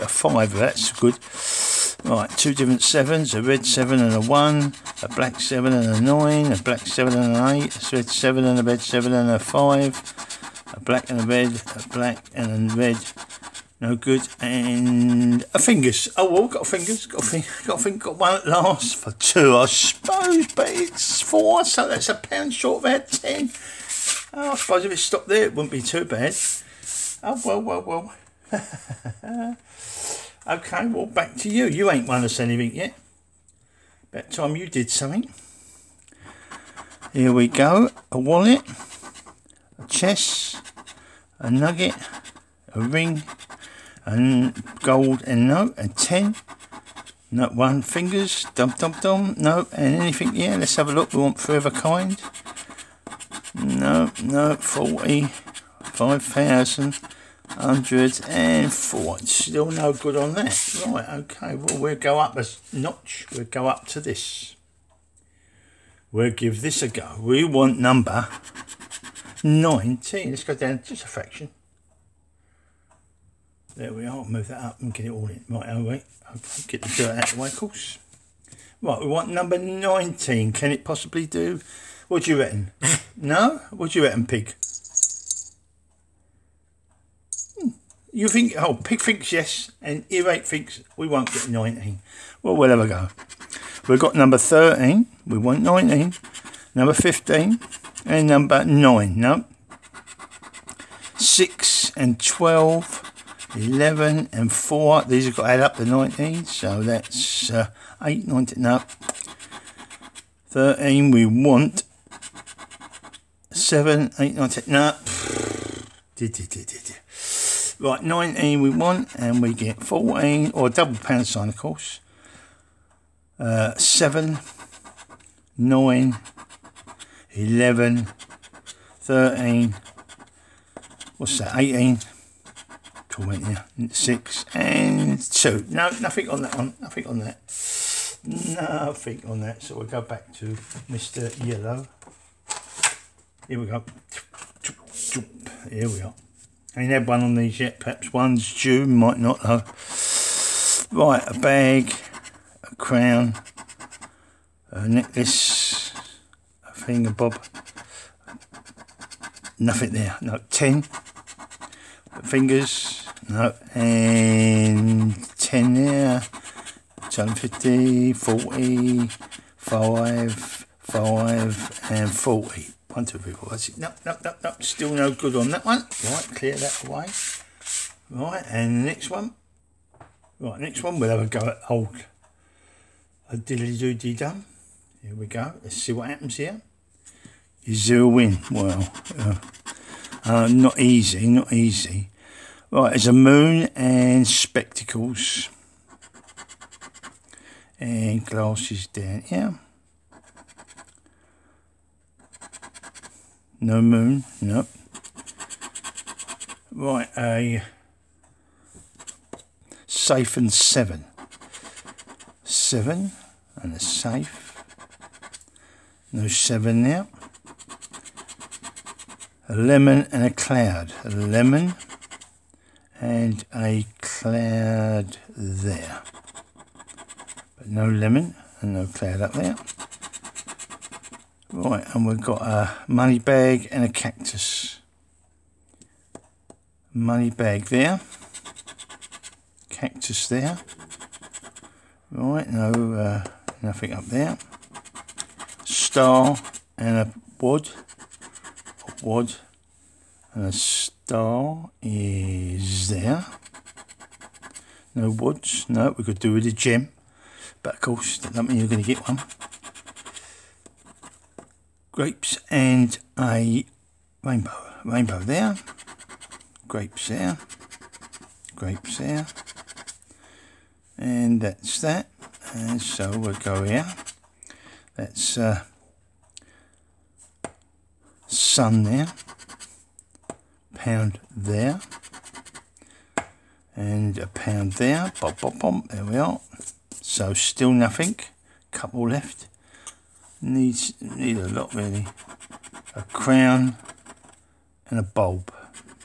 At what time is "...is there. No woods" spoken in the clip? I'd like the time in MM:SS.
04:11.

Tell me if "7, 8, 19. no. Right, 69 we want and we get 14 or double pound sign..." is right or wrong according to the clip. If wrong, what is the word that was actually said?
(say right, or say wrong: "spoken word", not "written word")
wrong: "19", not "69".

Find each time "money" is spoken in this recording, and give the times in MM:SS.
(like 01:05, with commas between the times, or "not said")
03:52, 03:56.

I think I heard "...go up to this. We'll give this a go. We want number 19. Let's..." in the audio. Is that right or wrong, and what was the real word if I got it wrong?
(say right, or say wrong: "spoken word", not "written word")
right.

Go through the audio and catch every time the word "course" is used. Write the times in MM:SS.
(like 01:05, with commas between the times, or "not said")
01:17, 02:01, 04:17.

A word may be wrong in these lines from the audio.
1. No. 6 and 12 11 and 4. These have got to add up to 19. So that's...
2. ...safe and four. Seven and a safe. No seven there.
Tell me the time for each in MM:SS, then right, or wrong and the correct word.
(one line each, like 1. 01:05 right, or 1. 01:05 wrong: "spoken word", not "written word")
1. 01:39 right
2. 03:29 wrong: "seven", not "four".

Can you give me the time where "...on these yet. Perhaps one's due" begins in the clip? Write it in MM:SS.
02:27.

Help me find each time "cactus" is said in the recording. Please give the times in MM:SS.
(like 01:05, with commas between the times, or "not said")
03:53, 03:59.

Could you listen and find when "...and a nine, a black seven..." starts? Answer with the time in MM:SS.
00:05.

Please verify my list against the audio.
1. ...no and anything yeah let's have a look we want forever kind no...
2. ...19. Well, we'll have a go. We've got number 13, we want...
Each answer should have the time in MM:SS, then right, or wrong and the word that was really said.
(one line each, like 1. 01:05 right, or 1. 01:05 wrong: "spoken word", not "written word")
1. 00:49 right
2. 01:31 right.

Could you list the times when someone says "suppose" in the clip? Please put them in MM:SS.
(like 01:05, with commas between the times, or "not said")
00:19, 00:24.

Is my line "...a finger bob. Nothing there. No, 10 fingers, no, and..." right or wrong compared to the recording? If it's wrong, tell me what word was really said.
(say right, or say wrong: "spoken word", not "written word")
right.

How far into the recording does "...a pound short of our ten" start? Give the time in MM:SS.
00:22.